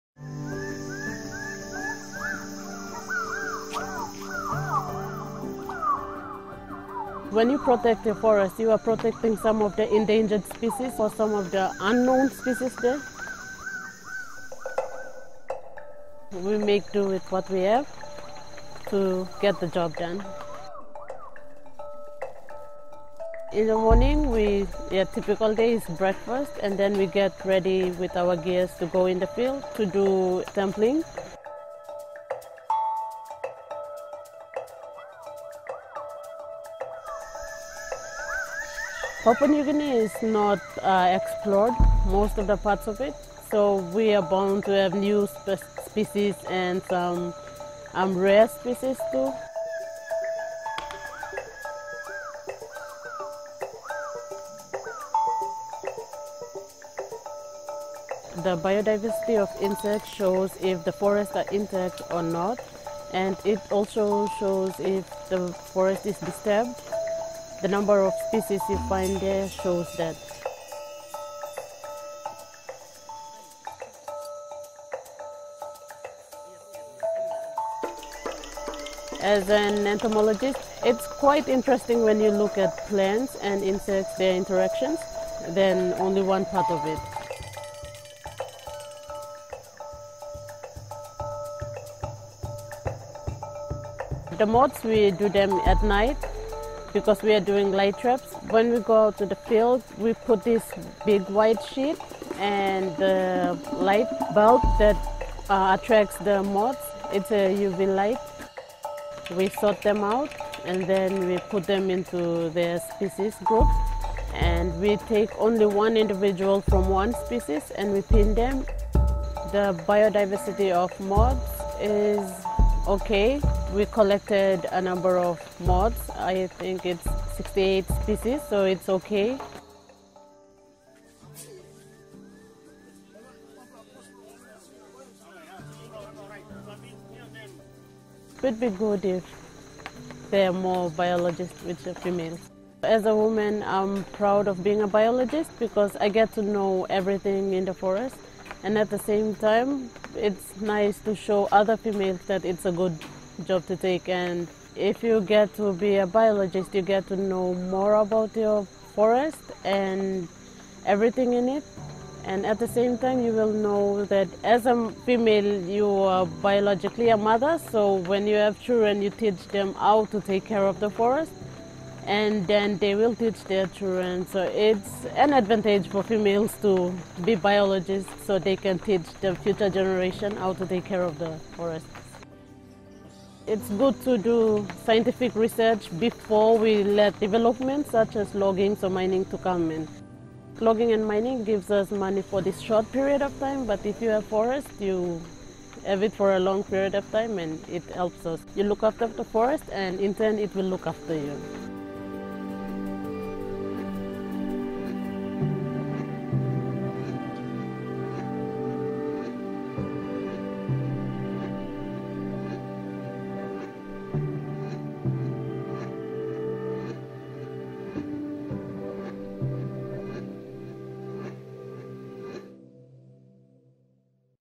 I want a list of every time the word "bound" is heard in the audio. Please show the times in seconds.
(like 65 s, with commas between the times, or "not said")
44 s.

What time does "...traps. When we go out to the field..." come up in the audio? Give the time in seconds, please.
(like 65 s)
97 s.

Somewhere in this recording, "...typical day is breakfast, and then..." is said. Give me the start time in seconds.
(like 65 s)
25 s.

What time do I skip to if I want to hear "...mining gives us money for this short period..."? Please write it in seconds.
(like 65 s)
191 s.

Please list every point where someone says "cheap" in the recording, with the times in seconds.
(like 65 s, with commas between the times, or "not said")
not said.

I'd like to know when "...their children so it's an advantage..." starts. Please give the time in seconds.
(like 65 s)
173 s.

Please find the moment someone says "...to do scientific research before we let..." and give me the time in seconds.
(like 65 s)
184 s.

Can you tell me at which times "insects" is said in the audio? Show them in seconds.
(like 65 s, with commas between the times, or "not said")
59 s, 83 s.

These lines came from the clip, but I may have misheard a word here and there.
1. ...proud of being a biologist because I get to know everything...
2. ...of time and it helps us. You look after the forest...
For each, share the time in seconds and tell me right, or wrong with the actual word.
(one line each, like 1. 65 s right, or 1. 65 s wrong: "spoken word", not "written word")
1. 144 s right
2. 196 s right.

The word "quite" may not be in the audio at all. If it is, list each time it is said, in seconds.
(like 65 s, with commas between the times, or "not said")
81 s.